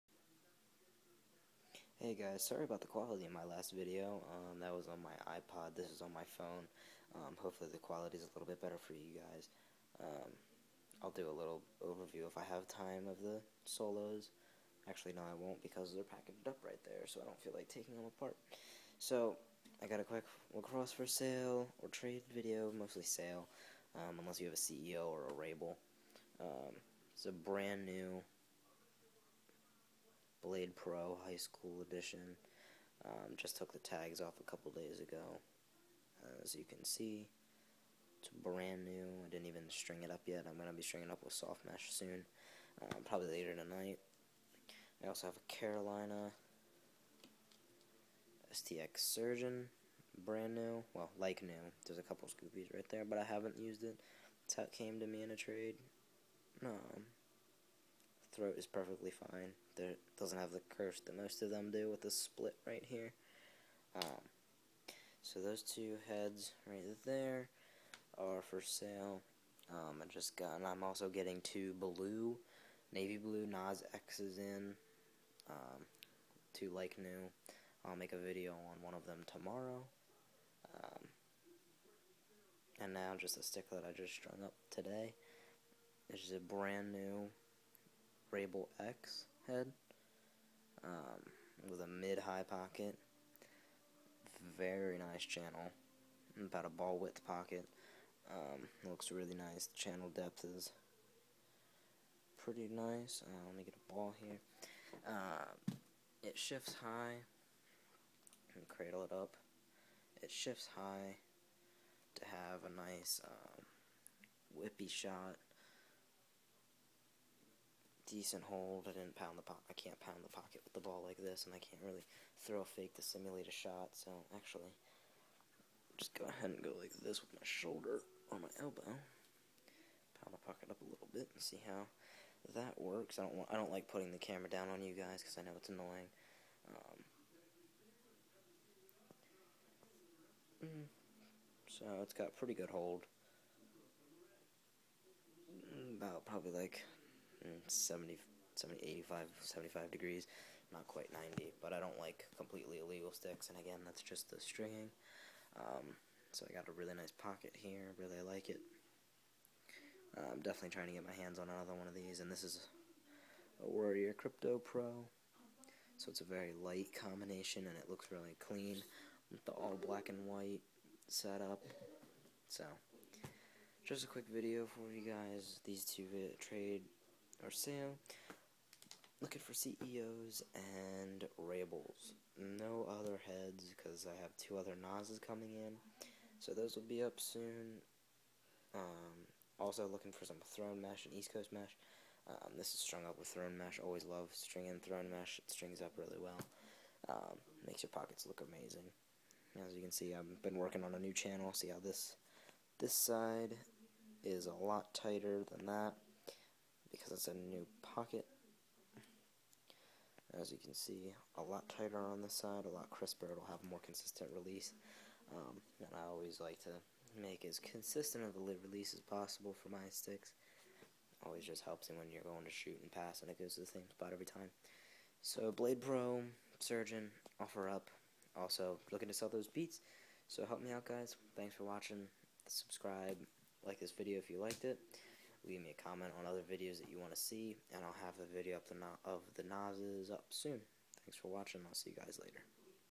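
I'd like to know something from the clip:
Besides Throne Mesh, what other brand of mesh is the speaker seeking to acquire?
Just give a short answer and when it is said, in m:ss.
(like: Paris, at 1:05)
East Coast Mesh, at 3:11.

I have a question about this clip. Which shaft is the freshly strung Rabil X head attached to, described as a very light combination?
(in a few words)
Warrior Krypto Pro.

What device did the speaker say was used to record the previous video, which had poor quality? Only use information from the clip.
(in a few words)
iPod.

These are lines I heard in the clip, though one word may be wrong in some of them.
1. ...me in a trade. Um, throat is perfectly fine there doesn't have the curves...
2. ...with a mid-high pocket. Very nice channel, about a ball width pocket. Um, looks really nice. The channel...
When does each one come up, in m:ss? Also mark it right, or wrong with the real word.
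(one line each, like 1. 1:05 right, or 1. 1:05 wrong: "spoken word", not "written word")
1. 0:55 right
2. 1:31 right.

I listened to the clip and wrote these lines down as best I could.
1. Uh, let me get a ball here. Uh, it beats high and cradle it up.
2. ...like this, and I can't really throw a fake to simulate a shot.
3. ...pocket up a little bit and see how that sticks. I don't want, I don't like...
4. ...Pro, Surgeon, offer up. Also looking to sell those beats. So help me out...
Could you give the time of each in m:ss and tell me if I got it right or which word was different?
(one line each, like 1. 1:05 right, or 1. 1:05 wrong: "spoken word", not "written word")
1. 1:43 wrong: "shifts", not "beats"
2. 2:01 right
3. 2:10 wrong: "works", not "sticks"
4. 3:45 right.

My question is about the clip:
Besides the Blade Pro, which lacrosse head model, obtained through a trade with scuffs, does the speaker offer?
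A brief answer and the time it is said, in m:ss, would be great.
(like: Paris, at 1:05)
Carolina STX Surgeon, at 0:45.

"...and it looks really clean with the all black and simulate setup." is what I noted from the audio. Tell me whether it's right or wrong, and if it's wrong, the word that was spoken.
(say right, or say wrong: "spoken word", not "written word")
wrong: "white", not "simulate".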